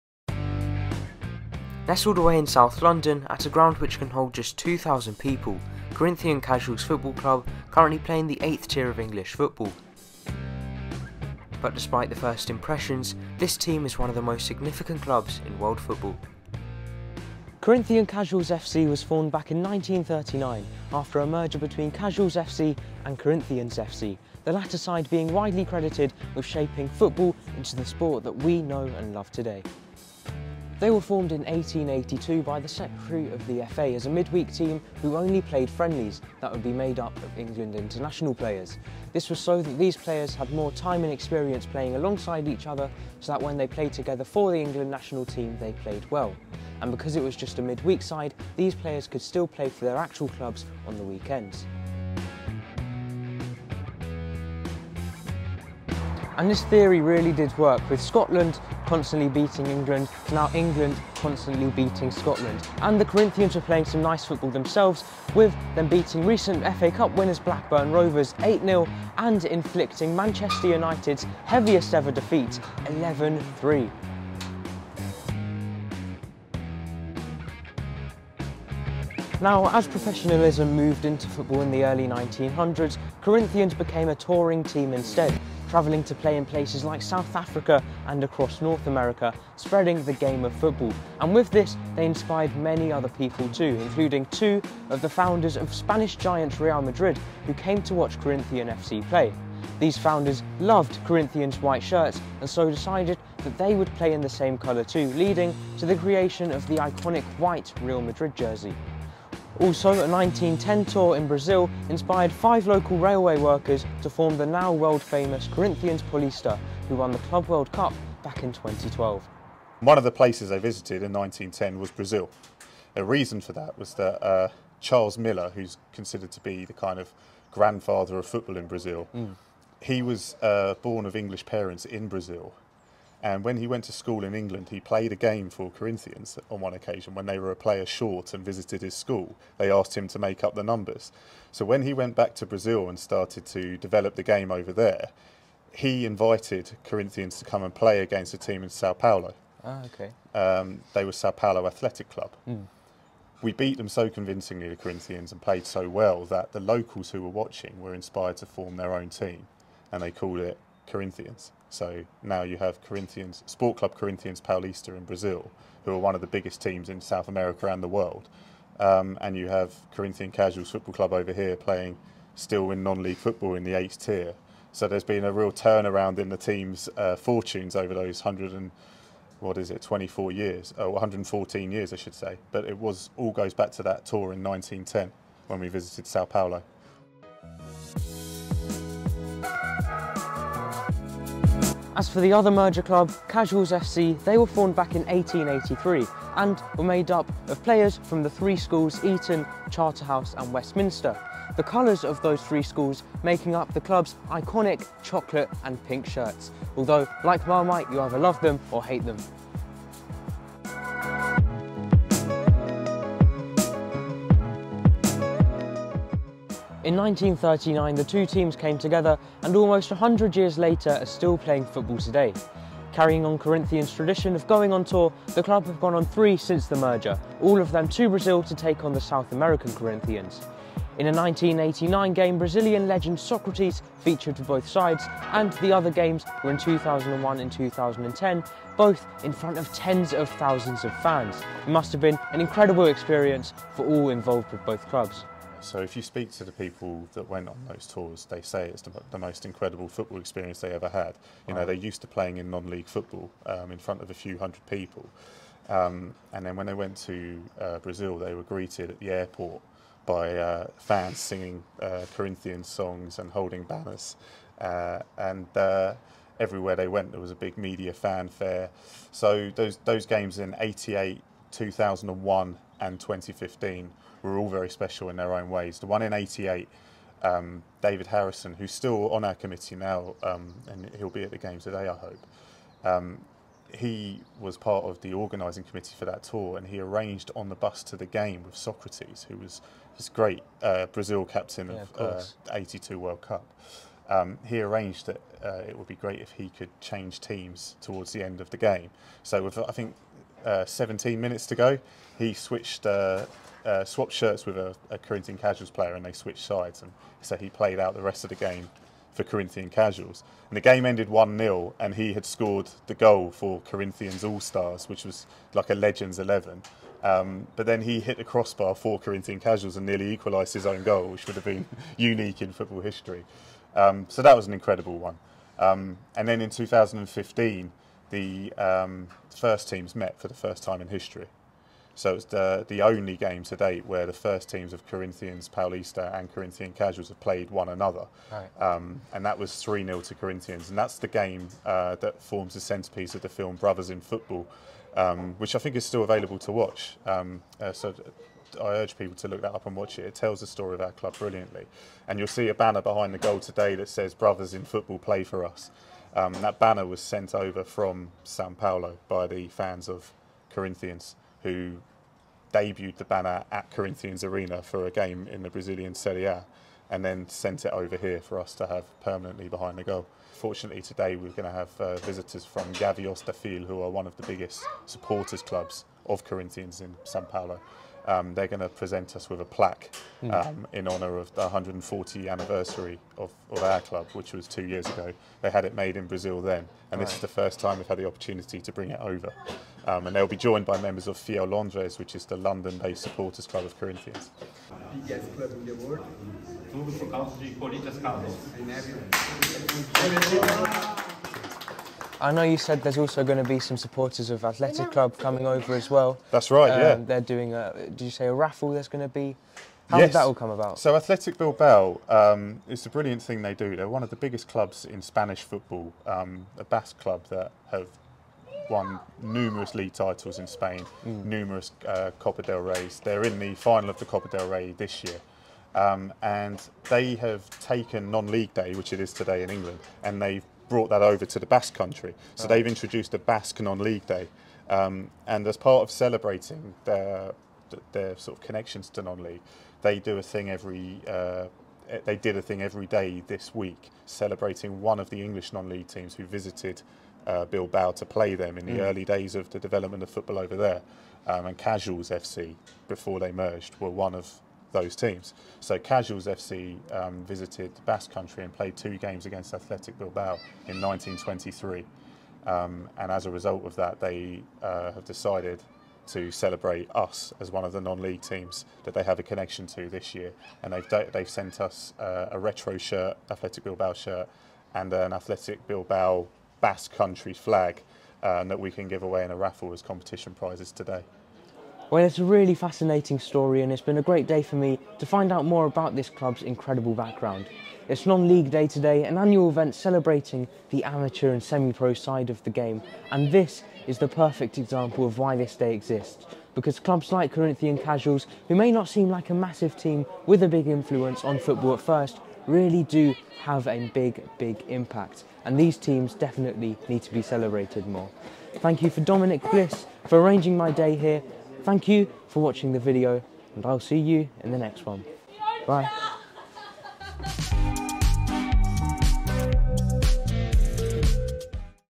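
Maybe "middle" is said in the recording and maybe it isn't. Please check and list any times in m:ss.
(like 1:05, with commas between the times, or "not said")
not said.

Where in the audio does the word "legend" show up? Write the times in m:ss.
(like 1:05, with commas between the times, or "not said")
3:52, 5:15.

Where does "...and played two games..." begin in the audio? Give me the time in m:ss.
7:38.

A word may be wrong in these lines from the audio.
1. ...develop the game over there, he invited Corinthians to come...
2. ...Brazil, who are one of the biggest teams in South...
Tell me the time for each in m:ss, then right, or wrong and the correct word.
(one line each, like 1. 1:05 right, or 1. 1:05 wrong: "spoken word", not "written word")
1. 2:23 right
2. 2:45 right.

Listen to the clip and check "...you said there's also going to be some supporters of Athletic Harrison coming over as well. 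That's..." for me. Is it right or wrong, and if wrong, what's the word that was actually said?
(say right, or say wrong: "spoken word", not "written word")
wrong: "Club", not "Harrison".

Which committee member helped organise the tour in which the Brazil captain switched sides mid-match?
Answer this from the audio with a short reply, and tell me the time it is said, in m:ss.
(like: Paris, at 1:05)
David Harrison, at 4:37.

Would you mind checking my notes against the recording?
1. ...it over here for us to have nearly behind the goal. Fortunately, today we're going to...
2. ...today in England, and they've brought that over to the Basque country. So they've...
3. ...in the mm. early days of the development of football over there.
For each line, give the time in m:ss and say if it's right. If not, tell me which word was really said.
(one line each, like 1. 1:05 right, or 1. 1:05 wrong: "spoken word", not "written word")
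1. 6:07 wrong: "permanently", not "nearly"
2. 7:09 right
3. 7:28 right.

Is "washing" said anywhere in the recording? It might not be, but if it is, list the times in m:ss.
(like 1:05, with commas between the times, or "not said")
not said.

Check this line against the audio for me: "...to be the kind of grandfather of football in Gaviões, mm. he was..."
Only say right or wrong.
wrong.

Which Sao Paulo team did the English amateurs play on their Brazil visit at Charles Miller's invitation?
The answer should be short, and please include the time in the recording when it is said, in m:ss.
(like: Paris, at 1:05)
Sao Paulo Athletic Club, at 2:31.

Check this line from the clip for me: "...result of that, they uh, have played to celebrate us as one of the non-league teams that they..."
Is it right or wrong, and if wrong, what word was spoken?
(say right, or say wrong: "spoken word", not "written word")
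wrong: "decided", not "played".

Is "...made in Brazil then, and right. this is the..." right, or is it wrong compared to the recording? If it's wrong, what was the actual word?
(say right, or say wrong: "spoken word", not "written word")
right.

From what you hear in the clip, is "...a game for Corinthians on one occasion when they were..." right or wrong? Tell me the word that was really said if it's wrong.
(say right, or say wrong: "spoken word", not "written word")
right.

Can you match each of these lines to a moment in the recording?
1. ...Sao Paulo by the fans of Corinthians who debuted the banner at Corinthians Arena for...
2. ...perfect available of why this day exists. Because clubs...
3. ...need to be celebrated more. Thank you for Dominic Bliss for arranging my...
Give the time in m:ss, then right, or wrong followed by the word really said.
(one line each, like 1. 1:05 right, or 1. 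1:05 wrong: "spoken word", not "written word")
1. 5:58 right
2. 8:14 wrong: "example", not "available"
3. 8:26 right.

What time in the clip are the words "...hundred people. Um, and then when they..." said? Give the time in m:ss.
4:14.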